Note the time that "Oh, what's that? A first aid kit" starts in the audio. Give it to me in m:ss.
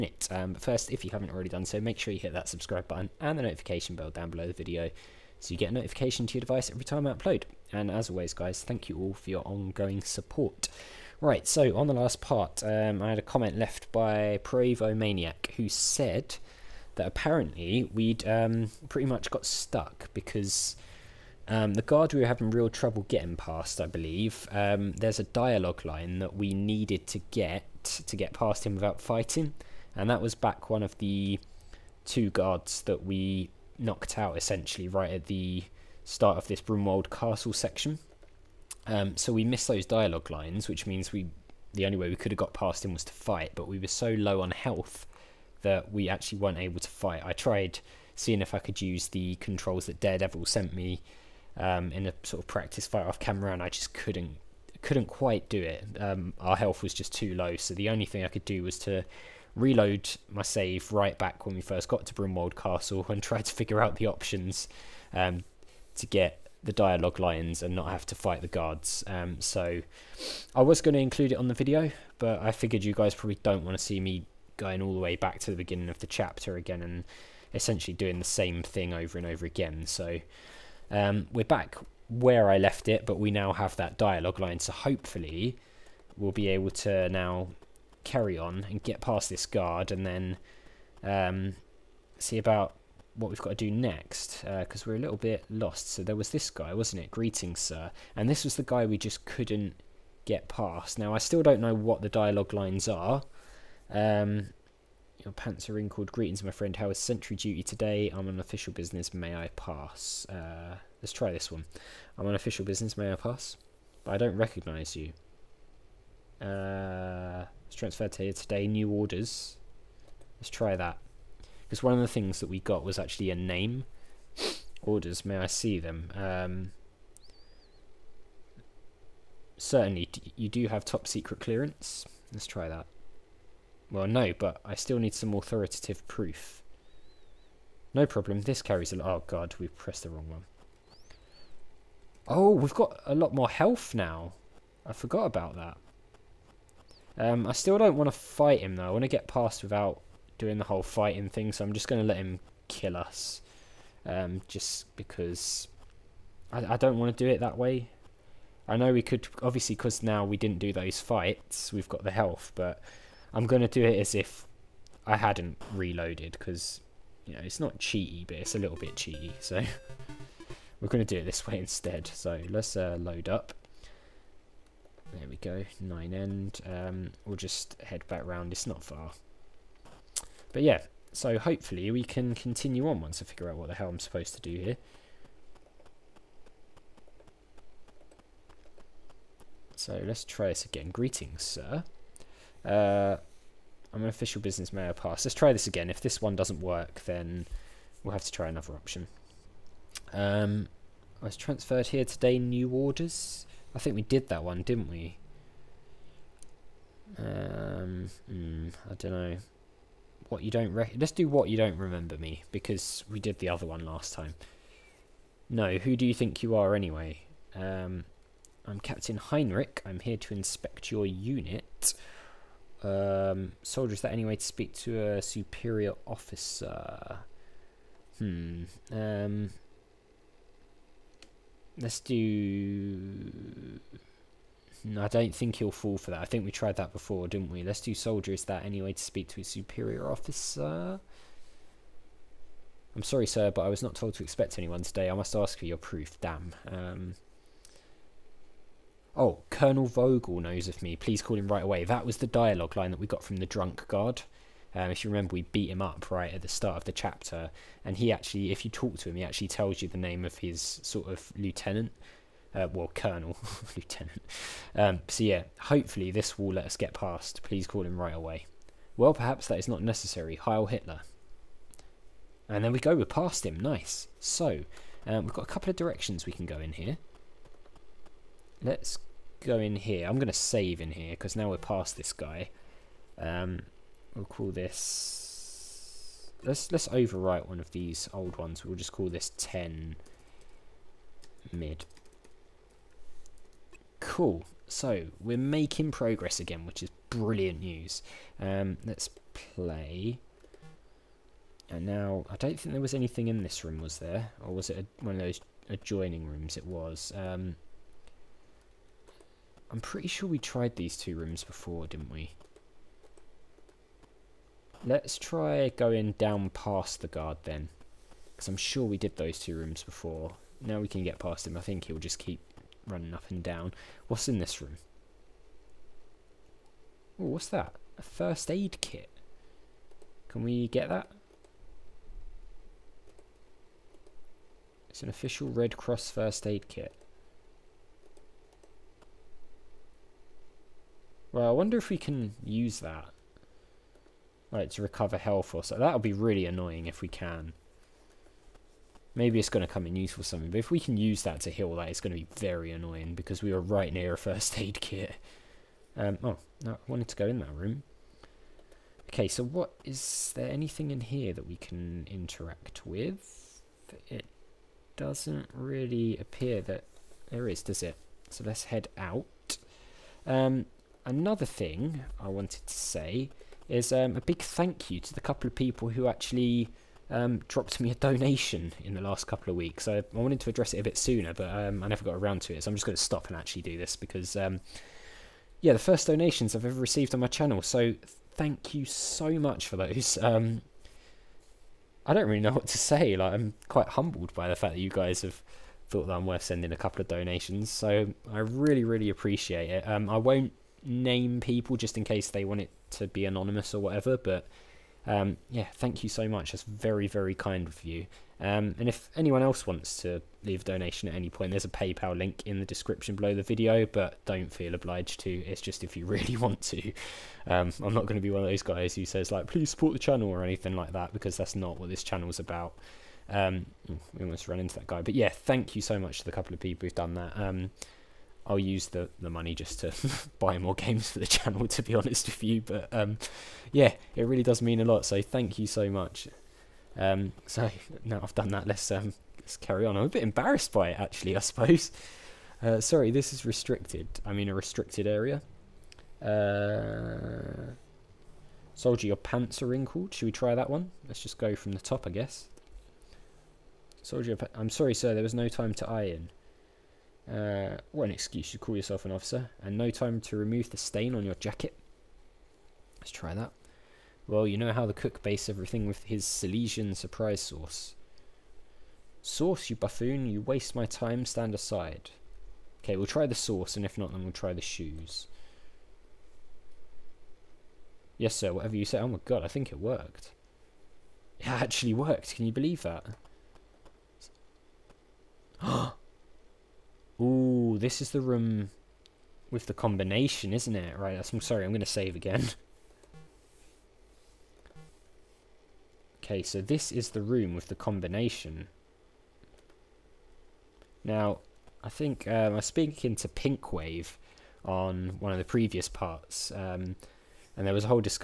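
5:27.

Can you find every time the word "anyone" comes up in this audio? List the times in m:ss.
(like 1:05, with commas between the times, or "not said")
4:04, 6:49.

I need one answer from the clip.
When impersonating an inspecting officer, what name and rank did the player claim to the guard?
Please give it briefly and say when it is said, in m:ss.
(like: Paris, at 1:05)
Captain Heinrich, at 3:38.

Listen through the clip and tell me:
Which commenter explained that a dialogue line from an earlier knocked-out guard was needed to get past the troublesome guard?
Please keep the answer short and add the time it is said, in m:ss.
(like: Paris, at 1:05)
Provo Maniac, at 0:14.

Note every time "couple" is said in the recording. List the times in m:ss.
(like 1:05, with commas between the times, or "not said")
4:35, 6:15, 6:19, 6:36, 7:06.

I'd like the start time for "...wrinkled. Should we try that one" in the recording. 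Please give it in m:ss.
7:29.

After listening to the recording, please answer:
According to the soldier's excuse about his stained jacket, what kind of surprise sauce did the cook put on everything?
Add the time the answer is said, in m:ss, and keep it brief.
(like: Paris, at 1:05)
Silesian, at 7:46.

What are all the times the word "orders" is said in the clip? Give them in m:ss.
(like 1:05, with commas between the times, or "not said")
1:58, 2:04, 3:22.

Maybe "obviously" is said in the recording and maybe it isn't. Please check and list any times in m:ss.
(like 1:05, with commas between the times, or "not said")
2:39.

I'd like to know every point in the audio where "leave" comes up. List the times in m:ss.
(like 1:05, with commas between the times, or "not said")
6:50.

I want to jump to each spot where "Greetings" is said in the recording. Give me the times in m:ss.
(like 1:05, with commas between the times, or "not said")
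1:37, 1:46, 3:10.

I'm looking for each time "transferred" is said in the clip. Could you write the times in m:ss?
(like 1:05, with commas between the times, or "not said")
1:57, 3:21.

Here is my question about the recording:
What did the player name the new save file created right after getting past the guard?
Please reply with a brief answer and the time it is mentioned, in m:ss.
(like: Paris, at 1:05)
10 mid, at 4:49.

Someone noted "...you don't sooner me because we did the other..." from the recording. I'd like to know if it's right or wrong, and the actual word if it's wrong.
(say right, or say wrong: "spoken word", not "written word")
wrong: "remember", not "sooner".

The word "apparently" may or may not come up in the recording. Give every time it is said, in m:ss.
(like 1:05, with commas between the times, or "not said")
0:17.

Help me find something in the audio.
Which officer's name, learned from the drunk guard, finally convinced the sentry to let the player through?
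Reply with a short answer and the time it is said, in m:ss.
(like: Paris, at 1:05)
Colonel Vogel, at 4:09.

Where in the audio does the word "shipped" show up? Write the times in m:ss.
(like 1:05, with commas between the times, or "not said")
not said.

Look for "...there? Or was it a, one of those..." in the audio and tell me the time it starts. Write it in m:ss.
5:03.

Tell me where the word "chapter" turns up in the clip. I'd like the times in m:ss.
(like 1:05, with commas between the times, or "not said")
1:16, 4:16.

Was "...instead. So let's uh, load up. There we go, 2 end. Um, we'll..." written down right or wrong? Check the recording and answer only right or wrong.
wrong.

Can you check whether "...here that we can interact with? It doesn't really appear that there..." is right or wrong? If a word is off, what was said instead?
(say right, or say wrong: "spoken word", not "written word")
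right.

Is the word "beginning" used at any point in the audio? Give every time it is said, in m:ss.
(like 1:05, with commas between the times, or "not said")
1:15.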